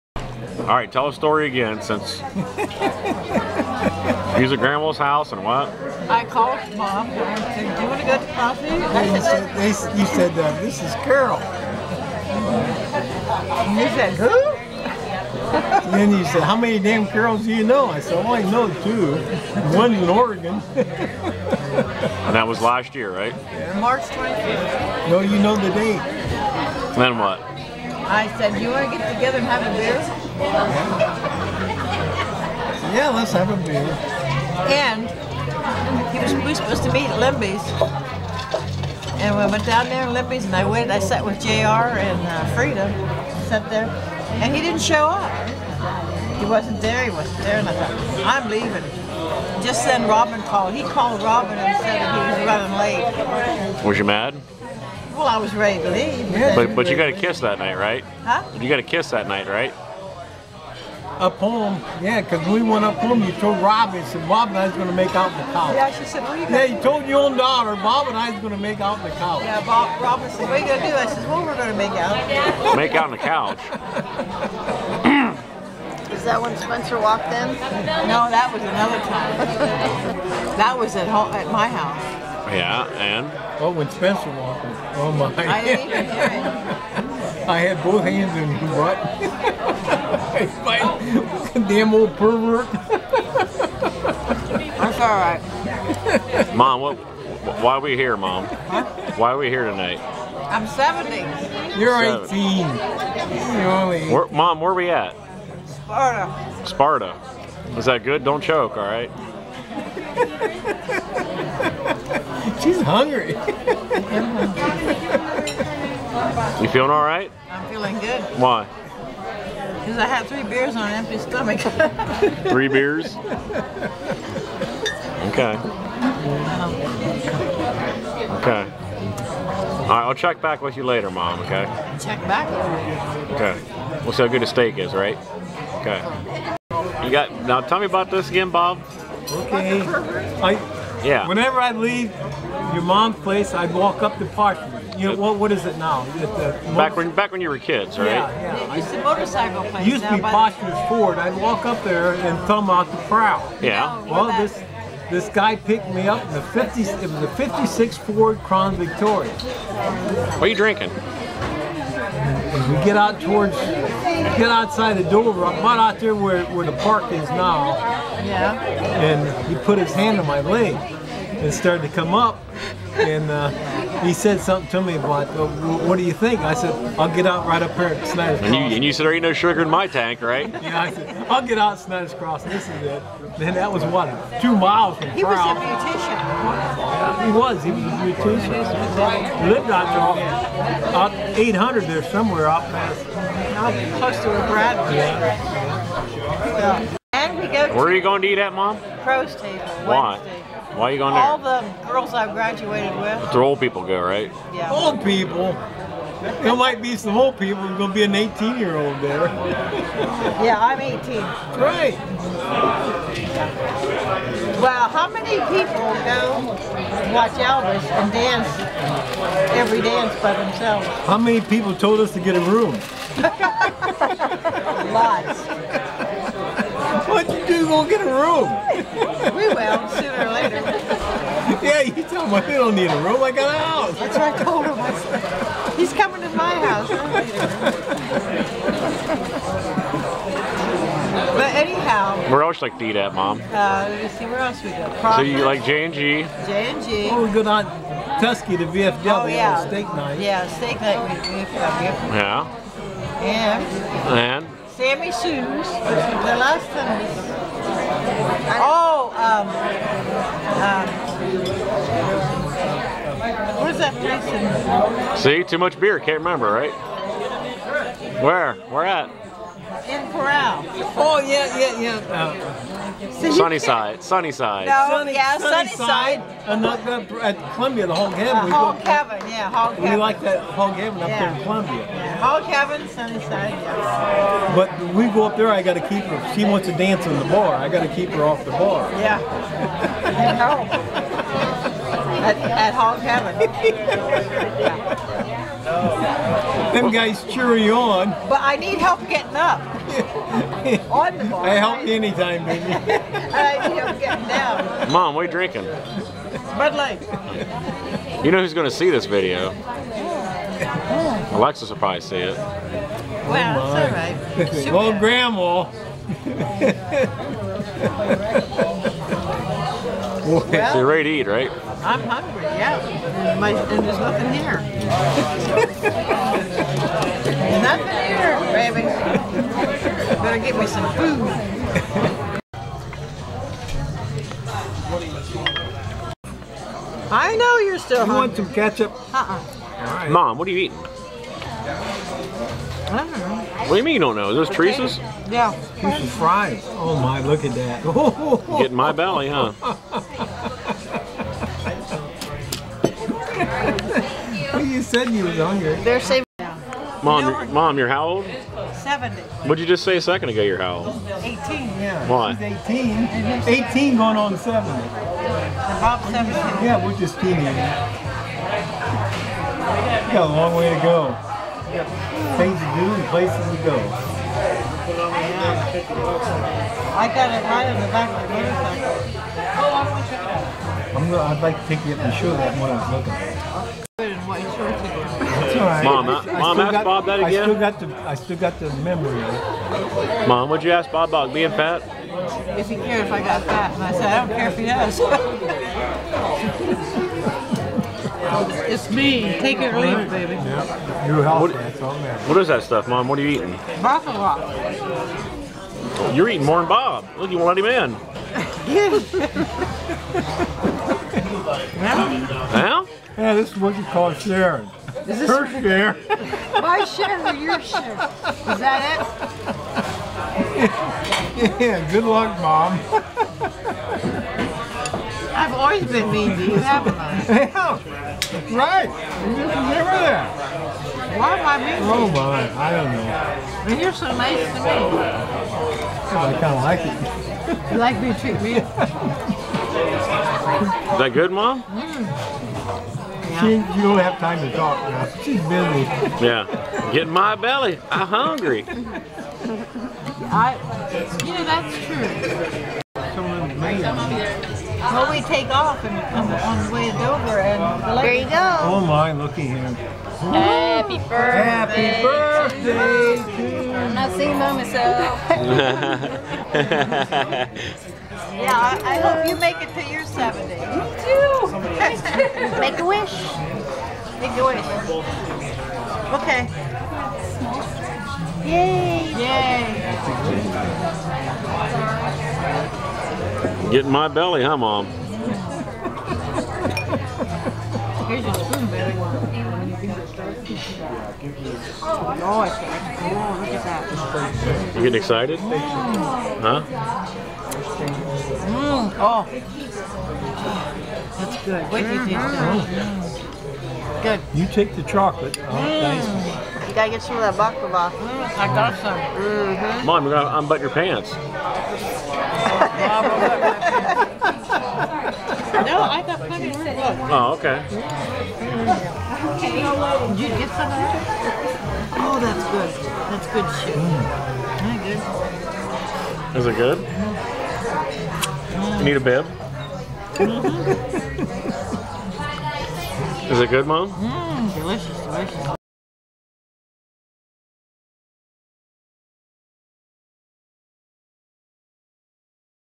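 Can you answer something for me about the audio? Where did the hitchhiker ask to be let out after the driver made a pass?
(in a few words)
Snyder's Crossing.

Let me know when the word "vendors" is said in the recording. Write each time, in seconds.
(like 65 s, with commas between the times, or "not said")
not said.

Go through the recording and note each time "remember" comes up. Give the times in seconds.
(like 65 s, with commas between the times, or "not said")
266 s, 429 s.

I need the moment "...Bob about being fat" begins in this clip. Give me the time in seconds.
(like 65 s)
390 s.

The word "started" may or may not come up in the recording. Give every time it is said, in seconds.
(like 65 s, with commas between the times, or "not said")
171 s.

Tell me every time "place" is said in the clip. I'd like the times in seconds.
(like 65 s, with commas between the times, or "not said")
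143 s, 149 s, 263 s, 373 s.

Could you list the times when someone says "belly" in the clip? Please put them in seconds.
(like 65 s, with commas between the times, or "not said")
348 s, 447 s, 484 s.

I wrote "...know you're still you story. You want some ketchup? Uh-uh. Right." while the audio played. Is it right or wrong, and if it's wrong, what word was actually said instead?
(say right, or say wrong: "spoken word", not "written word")
wrong: "hungry", not "story".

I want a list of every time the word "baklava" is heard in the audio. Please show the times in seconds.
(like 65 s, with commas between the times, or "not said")
507 s.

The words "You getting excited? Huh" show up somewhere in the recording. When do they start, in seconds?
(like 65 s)
494 s.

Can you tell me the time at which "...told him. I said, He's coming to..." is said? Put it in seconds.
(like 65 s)
234 s.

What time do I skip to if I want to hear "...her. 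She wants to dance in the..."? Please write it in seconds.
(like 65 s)
286 s.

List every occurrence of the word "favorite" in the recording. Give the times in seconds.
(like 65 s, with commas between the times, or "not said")
not said.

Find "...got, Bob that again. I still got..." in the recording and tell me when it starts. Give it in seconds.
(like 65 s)
386 s.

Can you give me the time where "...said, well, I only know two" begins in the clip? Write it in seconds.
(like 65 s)
17 s.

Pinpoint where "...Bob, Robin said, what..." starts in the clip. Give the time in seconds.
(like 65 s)
69 s.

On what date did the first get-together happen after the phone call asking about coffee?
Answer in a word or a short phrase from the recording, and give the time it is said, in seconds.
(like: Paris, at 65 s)
March 25th, at 23 s.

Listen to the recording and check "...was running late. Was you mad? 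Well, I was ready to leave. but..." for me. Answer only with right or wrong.
right.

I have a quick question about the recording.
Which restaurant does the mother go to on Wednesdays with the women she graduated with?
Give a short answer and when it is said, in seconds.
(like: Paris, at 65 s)
Crow's Table, at 199 s.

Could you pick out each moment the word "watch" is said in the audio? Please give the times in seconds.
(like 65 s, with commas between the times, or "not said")
217 s.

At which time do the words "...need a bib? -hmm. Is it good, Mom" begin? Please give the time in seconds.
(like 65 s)
528 s.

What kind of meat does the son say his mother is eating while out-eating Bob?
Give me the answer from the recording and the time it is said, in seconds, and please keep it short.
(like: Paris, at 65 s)
Buffalo, at 403 s.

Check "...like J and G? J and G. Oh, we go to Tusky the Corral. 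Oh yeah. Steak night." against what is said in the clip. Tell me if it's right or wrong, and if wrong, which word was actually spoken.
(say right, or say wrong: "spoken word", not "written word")
wrong: "VFW", not "Corral".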